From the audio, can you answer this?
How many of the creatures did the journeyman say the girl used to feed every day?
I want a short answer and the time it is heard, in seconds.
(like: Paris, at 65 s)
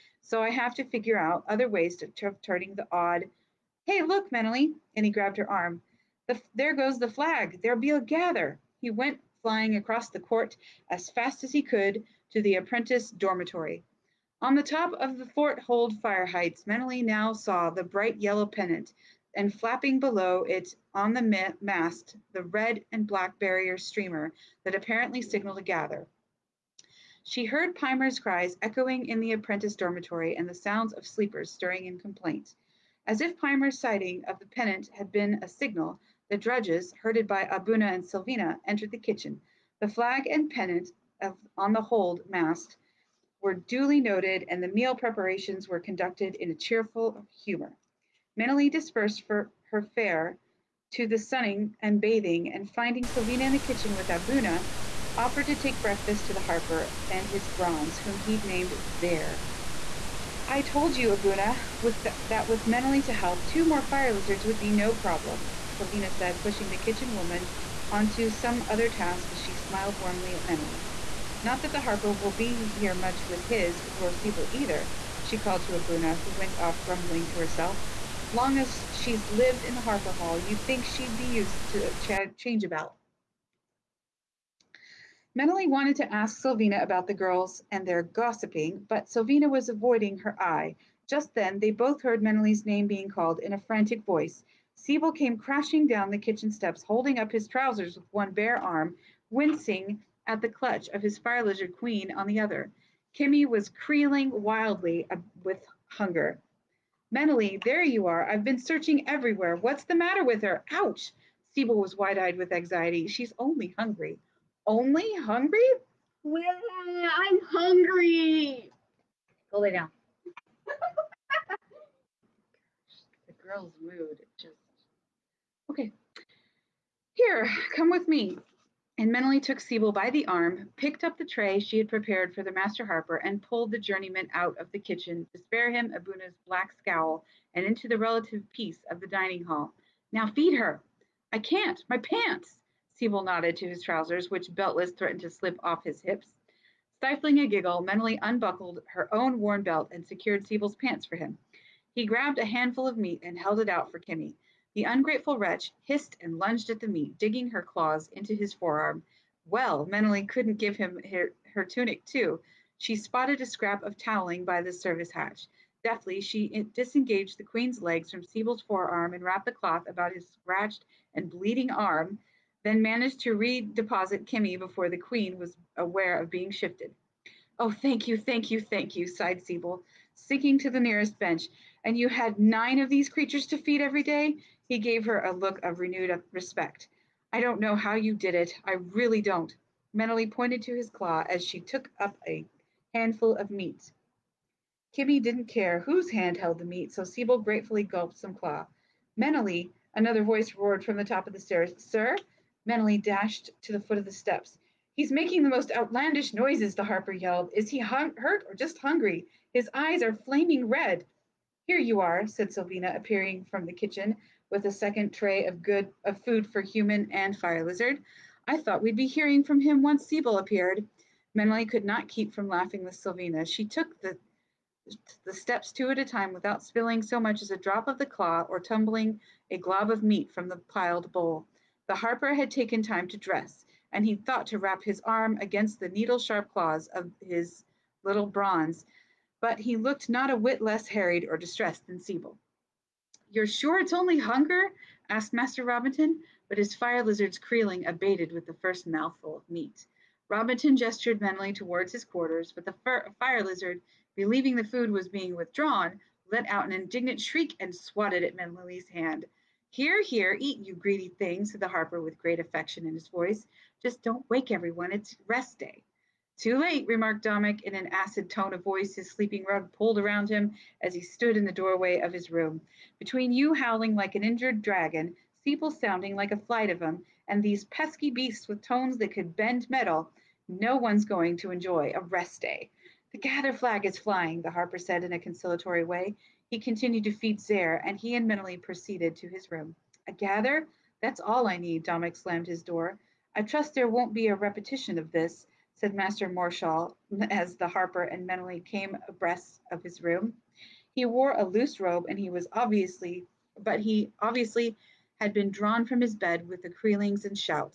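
9, at 182 s.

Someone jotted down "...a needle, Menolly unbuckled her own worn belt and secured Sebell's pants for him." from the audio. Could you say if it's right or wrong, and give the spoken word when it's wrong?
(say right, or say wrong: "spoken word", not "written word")
wrong: "giggle", not "needle".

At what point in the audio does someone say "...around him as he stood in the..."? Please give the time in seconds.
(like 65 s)
269 s.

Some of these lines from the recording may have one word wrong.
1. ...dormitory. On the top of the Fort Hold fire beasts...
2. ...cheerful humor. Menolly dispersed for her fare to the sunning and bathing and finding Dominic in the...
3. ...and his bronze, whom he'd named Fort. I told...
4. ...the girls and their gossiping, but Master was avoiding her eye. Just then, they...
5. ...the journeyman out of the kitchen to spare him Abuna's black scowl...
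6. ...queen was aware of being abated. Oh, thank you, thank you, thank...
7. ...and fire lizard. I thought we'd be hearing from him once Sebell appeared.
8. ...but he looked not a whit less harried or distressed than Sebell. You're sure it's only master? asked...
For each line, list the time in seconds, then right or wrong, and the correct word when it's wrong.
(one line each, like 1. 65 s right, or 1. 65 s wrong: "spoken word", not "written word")
1. 13 s wrong: "heights", not "beasts"
2. 46 s wrong: "Sylvina", not "Dominic"
3. 57 s wrong: "Zair", not "Fort"
4. 87 s wrong: "Sylvina", not "Master"
5. 133 s right
6. 174 s wrong: "shifted", not "abated"
7. 217 s right
8. 239 s wrong: "hunger", not "master".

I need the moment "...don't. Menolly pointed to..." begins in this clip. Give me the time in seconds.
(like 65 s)
189 s.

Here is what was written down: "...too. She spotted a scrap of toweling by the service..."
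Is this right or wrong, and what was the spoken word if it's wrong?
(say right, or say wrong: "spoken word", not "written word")
right.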